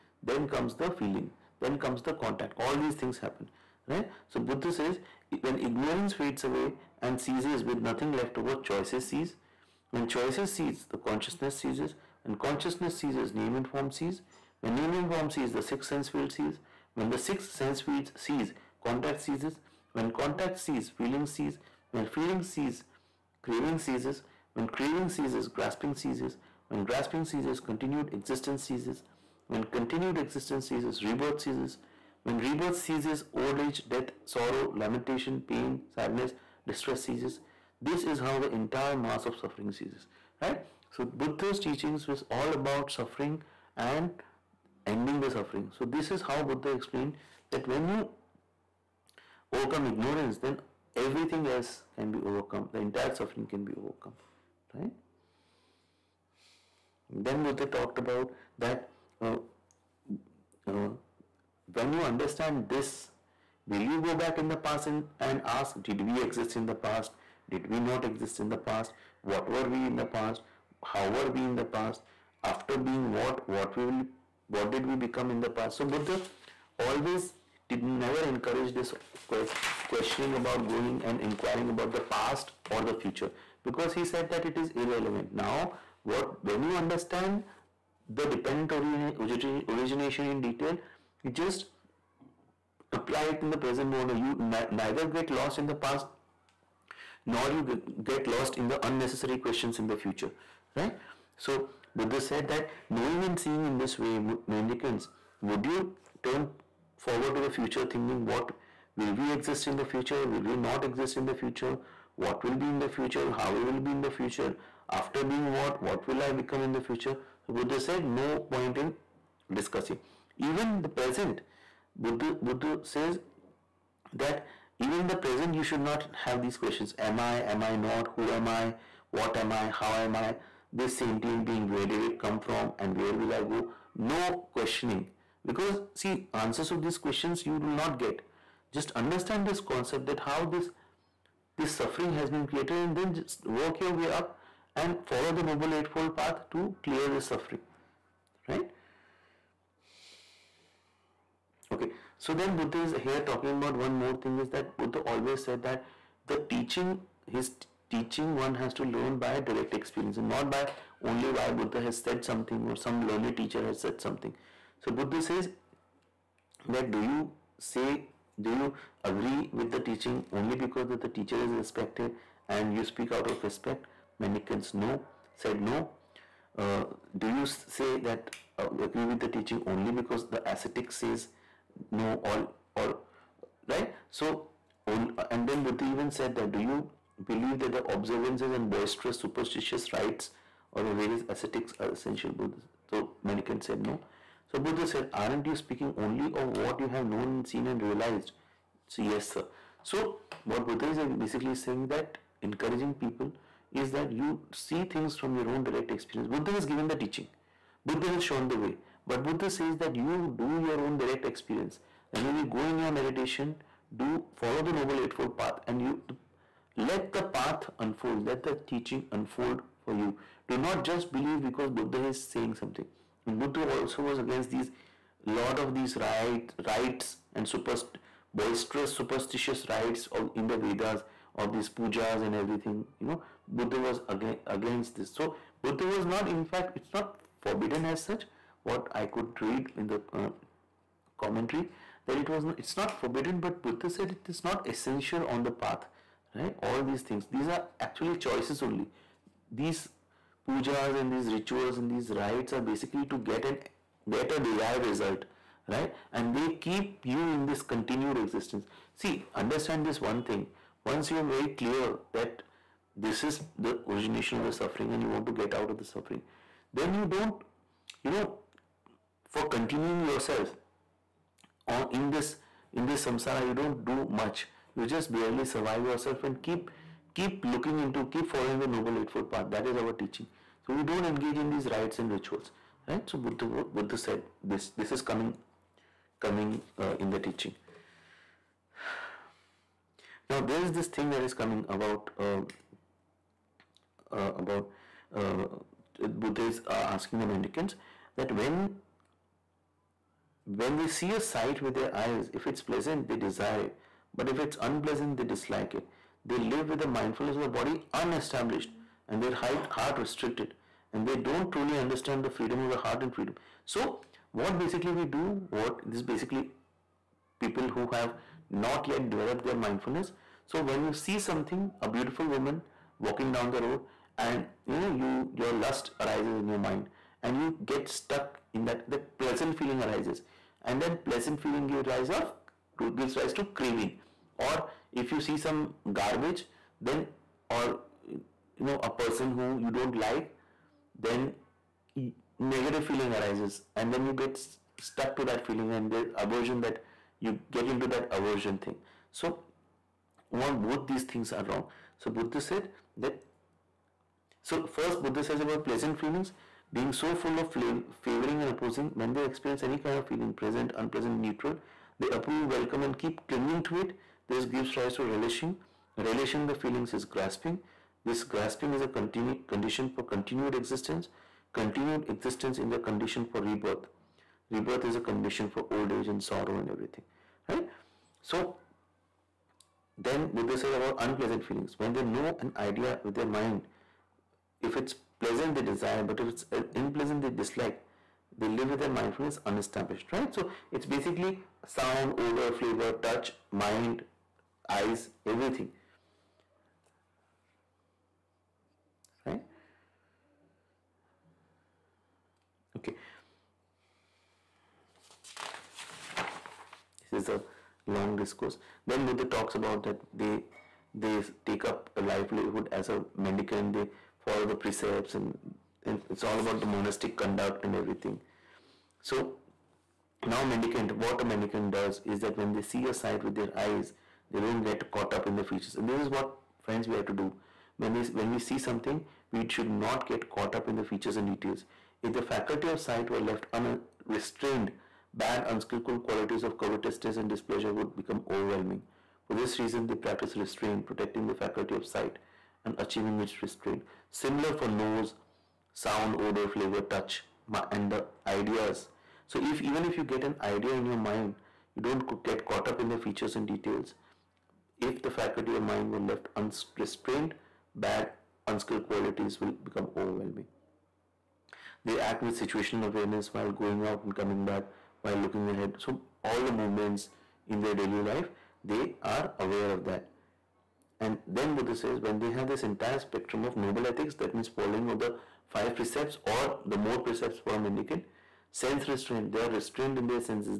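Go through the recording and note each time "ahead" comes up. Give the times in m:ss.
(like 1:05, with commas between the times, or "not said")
7:45.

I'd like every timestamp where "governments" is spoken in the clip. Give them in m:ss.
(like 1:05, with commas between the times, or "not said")
not said.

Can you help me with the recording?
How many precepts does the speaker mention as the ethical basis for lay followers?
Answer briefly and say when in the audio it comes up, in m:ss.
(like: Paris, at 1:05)
5, at 7:55.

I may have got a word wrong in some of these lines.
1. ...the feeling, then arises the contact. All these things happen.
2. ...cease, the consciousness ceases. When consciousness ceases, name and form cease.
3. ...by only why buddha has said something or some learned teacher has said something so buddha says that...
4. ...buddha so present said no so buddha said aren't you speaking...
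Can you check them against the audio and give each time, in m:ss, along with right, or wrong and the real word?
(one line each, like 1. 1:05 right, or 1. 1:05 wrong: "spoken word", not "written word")
1. 0:00 wrong: "comes", not "arises"
2. 0:10 right
3. 2:40 right
4. 3:12 wrong: "mendicant", not "present".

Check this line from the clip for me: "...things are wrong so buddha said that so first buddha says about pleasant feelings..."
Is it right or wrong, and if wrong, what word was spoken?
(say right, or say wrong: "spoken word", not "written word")
right.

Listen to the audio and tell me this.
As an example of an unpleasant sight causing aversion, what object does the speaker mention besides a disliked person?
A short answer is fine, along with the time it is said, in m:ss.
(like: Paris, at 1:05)
Garbage, at 5:35.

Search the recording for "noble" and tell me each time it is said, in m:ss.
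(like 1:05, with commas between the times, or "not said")
2:25, 3:34, 4:38, 7:53.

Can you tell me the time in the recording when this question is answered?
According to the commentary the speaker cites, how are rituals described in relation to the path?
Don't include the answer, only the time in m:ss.
4:04.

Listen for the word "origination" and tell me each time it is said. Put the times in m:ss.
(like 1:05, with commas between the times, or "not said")
1:29, 4:23.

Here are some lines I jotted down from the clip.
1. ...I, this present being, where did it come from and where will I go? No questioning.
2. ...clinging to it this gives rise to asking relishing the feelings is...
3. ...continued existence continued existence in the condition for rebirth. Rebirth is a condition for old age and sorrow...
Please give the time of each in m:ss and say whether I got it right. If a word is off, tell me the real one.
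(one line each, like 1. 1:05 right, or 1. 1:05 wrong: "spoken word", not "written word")
1. 2:10 wrong: "sentient", not "present"
2. 6:03 wrong: "relishing", not "asking"
3. 6:10 right.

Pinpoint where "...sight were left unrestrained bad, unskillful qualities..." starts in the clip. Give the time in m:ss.
7:12.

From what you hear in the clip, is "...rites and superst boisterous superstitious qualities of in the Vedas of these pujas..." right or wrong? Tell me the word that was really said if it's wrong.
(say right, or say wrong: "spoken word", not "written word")
wrong: "rites", not "qualities".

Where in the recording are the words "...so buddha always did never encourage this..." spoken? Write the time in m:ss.
1:15.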